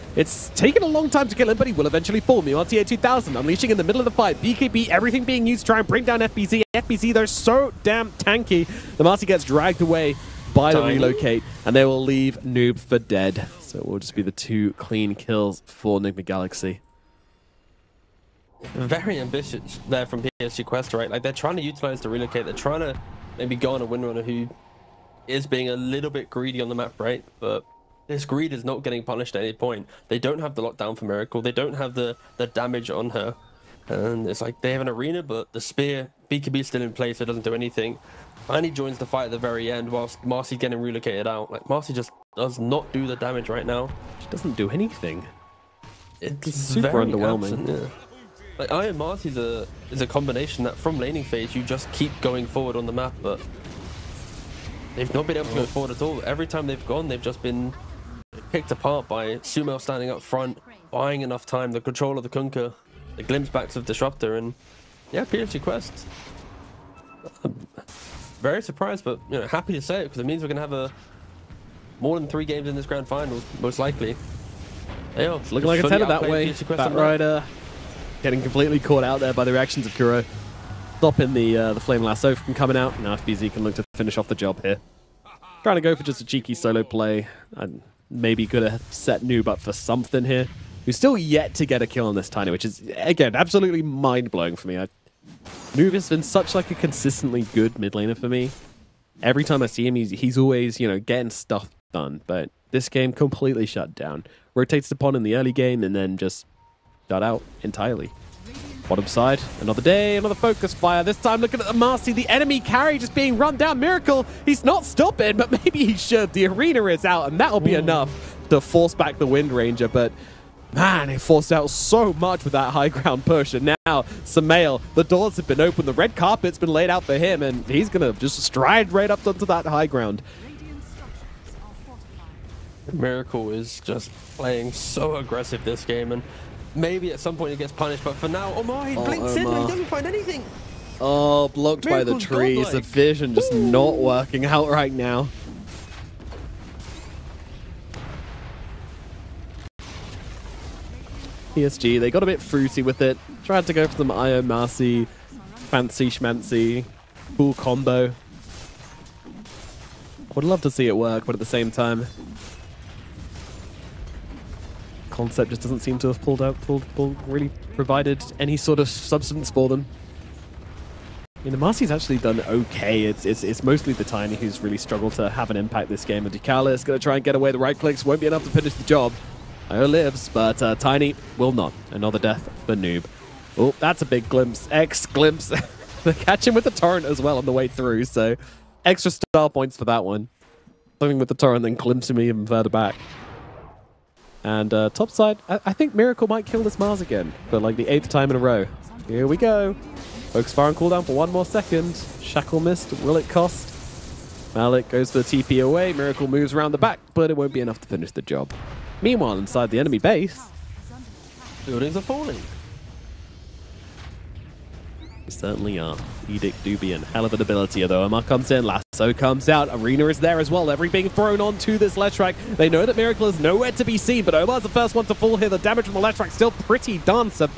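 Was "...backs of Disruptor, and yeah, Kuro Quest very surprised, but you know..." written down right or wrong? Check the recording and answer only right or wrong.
wrong.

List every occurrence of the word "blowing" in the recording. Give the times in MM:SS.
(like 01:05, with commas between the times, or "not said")
01:33.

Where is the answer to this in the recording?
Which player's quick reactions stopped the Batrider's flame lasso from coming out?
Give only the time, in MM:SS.
01:19.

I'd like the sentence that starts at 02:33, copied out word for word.
Tried to go for some Io Marci, fancy schmancy, cool combo.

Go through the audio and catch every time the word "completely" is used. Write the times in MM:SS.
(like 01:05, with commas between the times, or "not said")
01:18, 01:43.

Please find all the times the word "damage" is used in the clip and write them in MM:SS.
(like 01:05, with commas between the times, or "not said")
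00:32, 00:43, 03:45.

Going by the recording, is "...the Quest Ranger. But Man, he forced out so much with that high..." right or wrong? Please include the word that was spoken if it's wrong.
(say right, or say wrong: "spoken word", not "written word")
wrong: "Wind", not "Quest".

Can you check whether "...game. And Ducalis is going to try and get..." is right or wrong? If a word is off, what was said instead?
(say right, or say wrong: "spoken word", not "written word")
right.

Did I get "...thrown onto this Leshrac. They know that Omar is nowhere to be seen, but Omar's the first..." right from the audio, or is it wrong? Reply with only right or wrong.
wrong.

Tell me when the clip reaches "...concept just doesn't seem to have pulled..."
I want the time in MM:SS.
02:45.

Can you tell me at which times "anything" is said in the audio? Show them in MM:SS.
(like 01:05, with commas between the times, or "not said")
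00:37, 00:44, 02:20.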